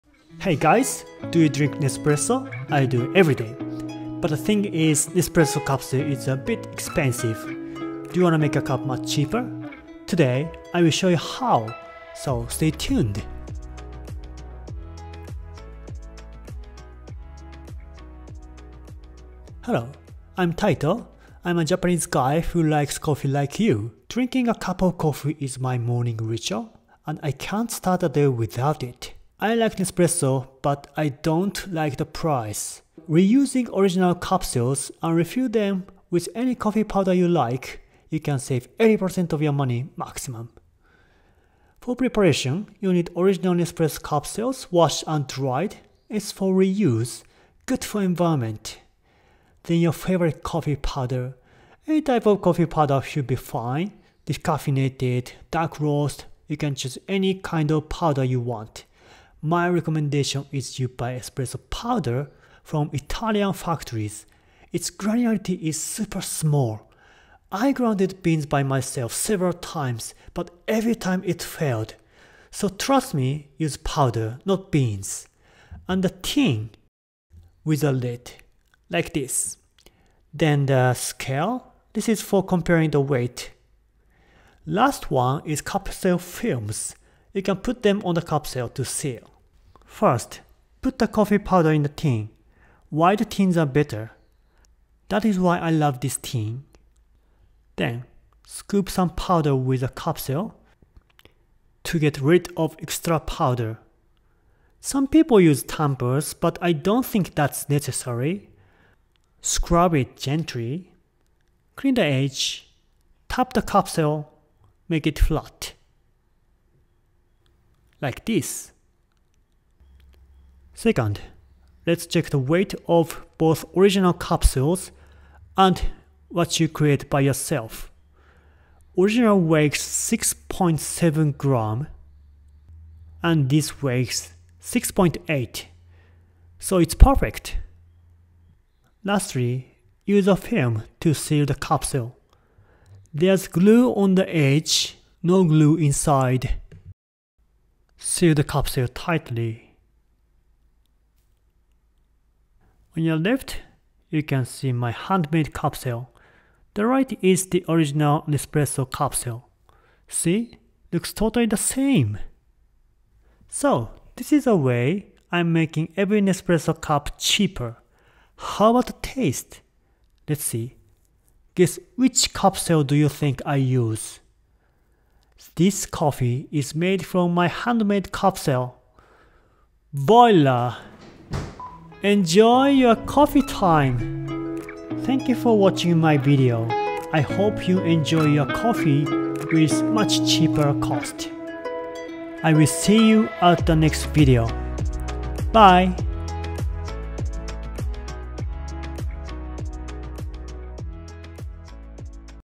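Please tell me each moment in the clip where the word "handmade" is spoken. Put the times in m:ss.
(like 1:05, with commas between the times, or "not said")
2:34, 2:57.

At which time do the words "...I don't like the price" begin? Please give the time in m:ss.
0:30.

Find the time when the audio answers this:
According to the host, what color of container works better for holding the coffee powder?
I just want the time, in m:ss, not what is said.
1:32.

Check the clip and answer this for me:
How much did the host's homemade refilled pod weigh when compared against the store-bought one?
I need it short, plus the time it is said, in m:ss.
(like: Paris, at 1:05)
6.8 grams, at 2:14.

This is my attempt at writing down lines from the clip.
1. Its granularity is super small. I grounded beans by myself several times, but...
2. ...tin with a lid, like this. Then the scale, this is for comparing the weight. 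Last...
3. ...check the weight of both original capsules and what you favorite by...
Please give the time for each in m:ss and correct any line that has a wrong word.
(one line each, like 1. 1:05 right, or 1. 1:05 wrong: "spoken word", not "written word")
1. 1:04 right
2. 1:16 right
3. 2:02 wrong: "create", not "favorite".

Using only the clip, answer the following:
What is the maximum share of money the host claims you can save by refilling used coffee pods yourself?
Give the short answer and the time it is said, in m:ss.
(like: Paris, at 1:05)
80%, at 0:38.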